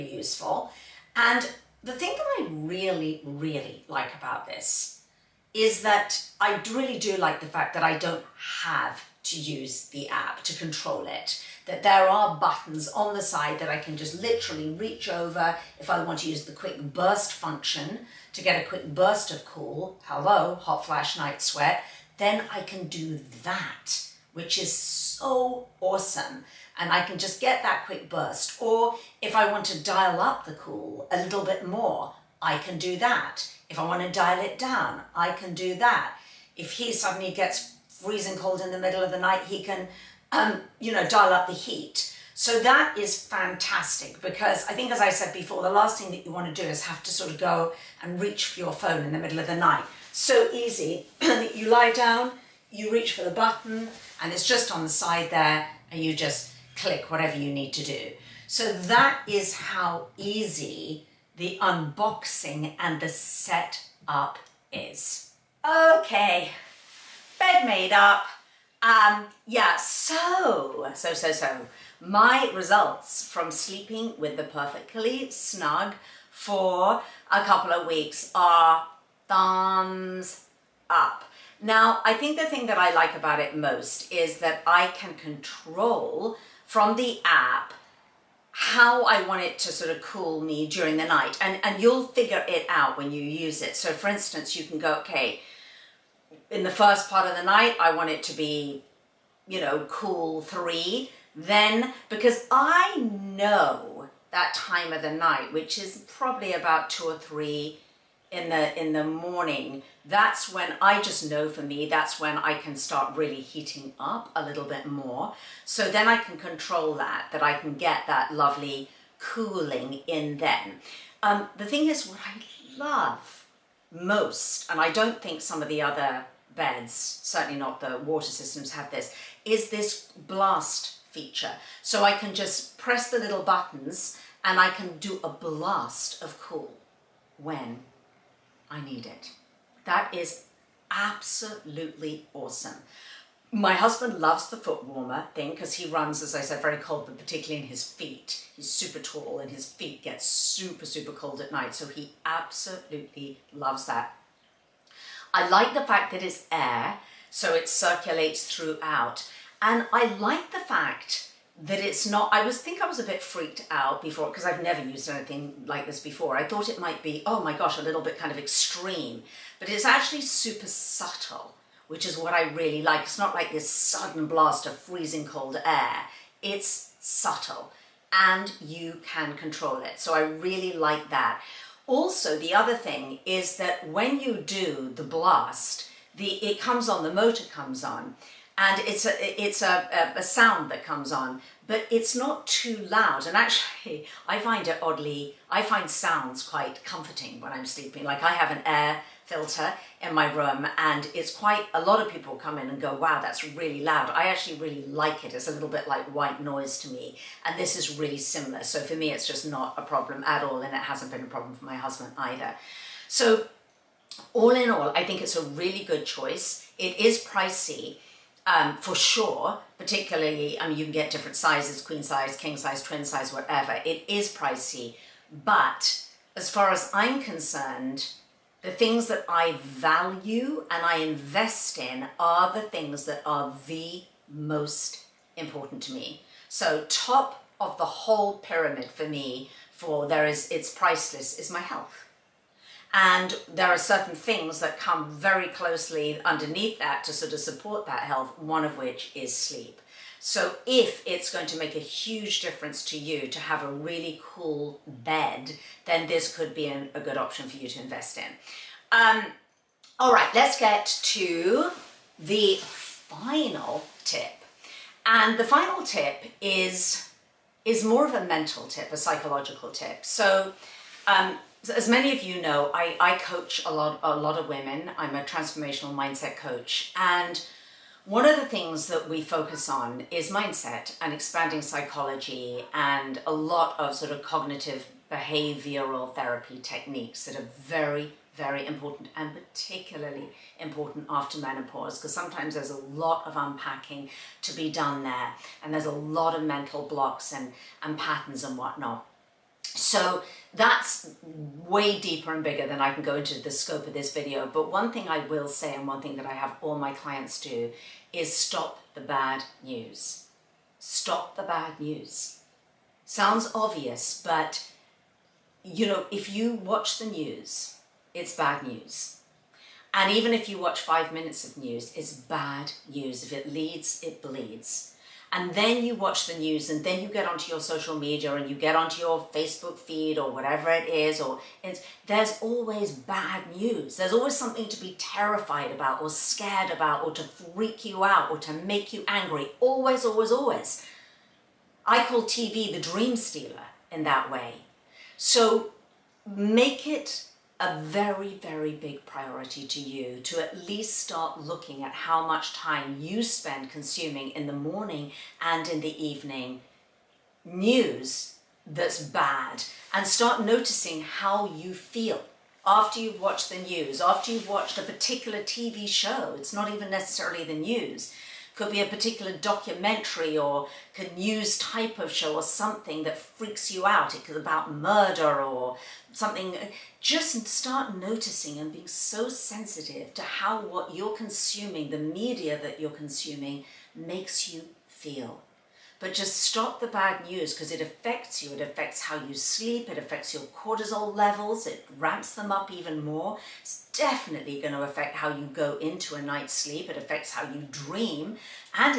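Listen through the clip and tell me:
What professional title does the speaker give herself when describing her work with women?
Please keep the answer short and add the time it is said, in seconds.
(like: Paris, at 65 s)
transformational mindset coach, at 275 s.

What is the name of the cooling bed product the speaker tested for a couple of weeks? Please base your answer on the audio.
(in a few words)
Perfectly Snug.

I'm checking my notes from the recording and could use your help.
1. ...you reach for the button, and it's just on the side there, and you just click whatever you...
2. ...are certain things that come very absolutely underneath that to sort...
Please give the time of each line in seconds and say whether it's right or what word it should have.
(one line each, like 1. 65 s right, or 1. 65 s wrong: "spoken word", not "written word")
1. 52 s right
2. 243 s wrong: "closely", not "absolutely".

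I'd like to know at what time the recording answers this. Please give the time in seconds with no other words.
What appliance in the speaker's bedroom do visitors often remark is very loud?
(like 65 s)
198 s.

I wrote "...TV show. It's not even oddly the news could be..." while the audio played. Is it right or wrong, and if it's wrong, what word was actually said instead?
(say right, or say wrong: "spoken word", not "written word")
wrong: "necessarily", not "oddly".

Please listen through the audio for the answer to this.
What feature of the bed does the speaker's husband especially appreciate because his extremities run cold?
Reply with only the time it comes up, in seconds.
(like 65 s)
144 s.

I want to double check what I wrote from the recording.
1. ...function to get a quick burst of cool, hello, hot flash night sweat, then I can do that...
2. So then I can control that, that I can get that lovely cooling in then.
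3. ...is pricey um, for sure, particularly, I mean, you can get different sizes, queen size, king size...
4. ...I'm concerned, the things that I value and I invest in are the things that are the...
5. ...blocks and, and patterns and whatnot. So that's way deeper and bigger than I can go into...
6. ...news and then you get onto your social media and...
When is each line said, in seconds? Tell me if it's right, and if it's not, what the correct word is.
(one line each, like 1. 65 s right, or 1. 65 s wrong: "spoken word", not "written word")
1. 17 s right
2. 115 s right
3. 216 s right
4. 226 s right
5. 296 s right
6. 326 s right.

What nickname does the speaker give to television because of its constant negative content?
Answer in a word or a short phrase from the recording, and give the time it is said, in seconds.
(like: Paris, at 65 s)
the dream stealer, at 342 s.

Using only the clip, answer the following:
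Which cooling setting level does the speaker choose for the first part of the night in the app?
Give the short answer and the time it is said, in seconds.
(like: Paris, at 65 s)
cool 3, at 99 s.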